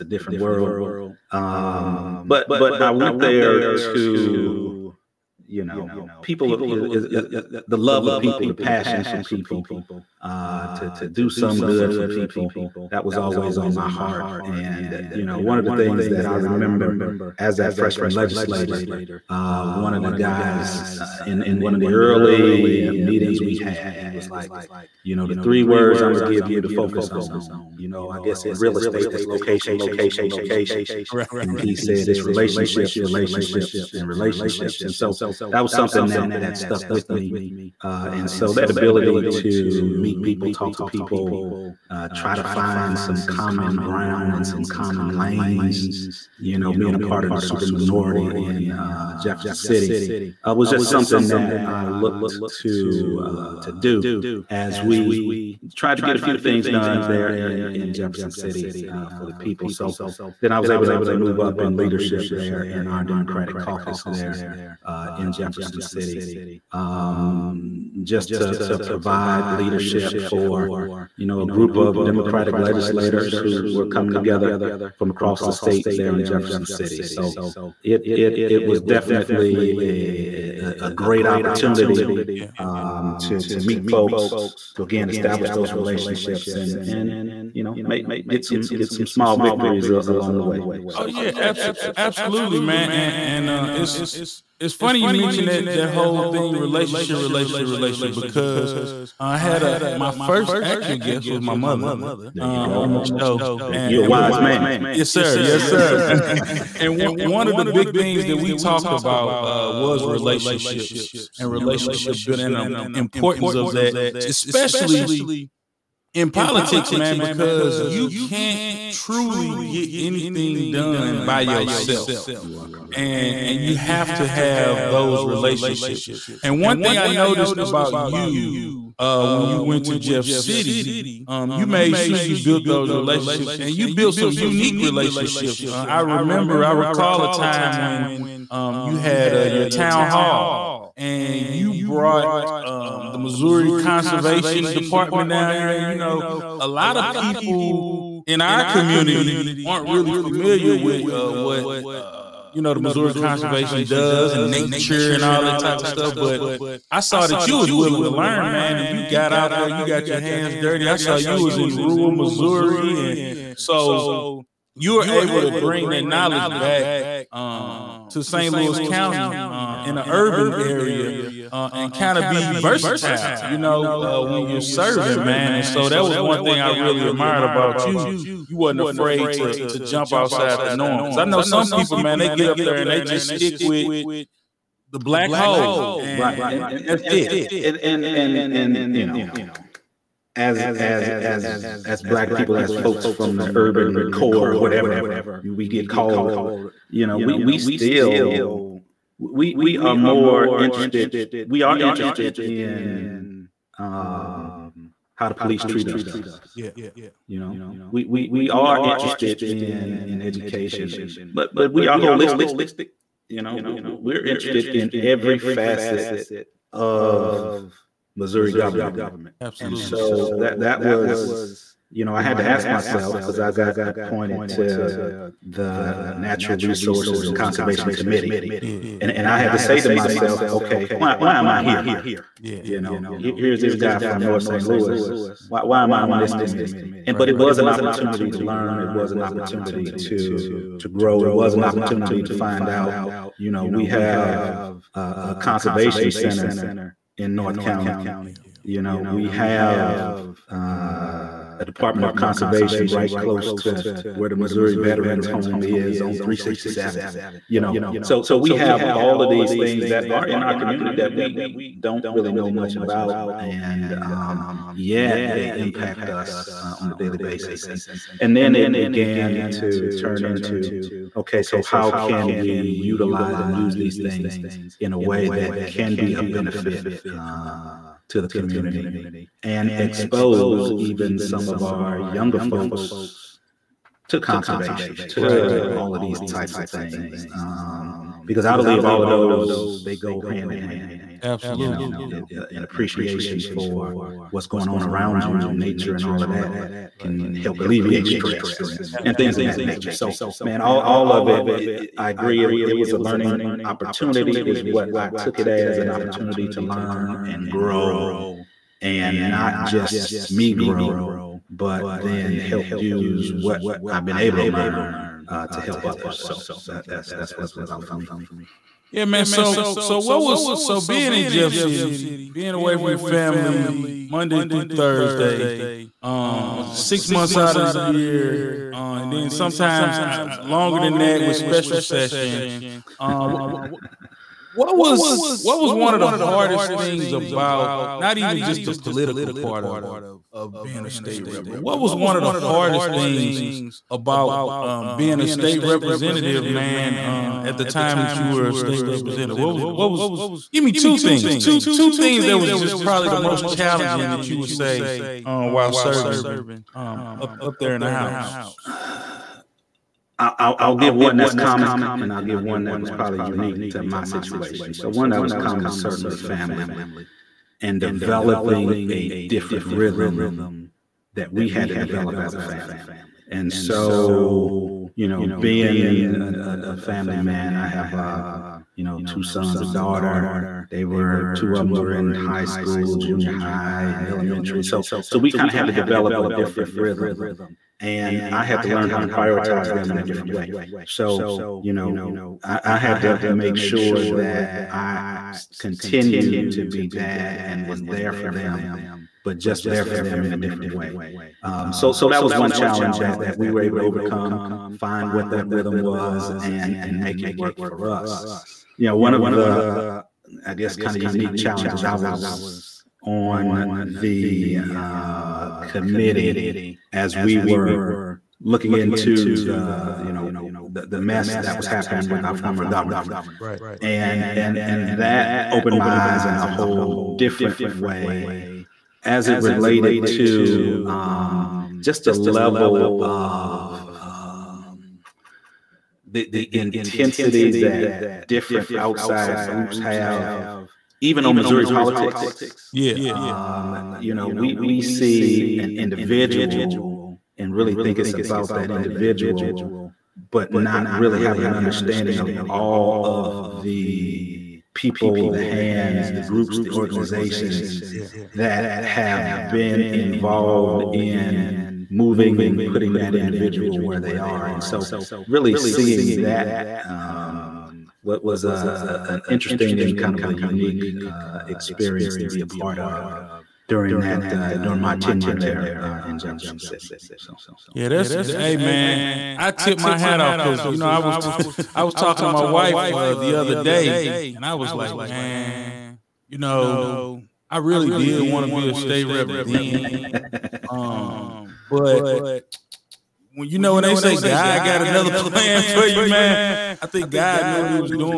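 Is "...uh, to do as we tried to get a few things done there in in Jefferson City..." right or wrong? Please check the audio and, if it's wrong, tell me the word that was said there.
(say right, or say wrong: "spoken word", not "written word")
right.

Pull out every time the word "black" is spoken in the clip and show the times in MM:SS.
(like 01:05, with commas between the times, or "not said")
03:05, 03:12.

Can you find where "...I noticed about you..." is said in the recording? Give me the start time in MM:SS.
02:06.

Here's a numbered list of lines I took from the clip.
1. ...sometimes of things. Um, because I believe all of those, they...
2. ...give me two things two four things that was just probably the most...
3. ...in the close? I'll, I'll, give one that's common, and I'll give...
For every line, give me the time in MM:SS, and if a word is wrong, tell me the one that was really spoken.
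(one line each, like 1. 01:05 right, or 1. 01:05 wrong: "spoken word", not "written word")
1. 04:46 wrong: "types", not "sometimes"
2. 05:50 wrong: "two", not "four"
3. 05:57 wrong: "house", not "close".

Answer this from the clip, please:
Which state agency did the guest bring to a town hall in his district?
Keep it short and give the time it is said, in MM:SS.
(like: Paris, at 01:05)
Missouri Conservation Department, at 02:23.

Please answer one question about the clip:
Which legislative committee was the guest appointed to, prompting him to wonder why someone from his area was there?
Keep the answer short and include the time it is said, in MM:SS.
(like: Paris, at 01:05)
Natural Resources and Conservation, at 03:46.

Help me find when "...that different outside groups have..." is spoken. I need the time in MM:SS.
07:17.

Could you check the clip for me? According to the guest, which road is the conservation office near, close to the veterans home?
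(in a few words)
367.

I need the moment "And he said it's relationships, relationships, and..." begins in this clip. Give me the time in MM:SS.
00:31.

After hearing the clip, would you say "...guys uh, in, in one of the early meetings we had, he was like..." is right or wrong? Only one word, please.
right.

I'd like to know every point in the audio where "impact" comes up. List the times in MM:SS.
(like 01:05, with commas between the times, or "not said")
04:25.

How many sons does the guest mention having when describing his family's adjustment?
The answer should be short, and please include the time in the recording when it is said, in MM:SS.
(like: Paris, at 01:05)
2, at 06:19.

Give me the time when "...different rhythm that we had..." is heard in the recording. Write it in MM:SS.
06:09.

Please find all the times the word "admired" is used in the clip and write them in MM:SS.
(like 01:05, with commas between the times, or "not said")
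02:57.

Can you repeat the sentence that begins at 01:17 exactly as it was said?
So it it it was definitely a a, a great opportunity yeah.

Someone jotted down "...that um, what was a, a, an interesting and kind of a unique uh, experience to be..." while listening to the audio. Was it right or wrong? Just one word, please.
right.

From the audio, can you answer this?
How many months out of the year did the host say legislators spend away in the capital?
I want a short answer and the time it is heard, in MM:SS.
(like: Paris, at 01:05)
6, at 05:26.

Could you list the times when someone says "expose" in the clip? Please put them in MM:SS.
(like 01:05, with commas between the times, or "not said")
04:39.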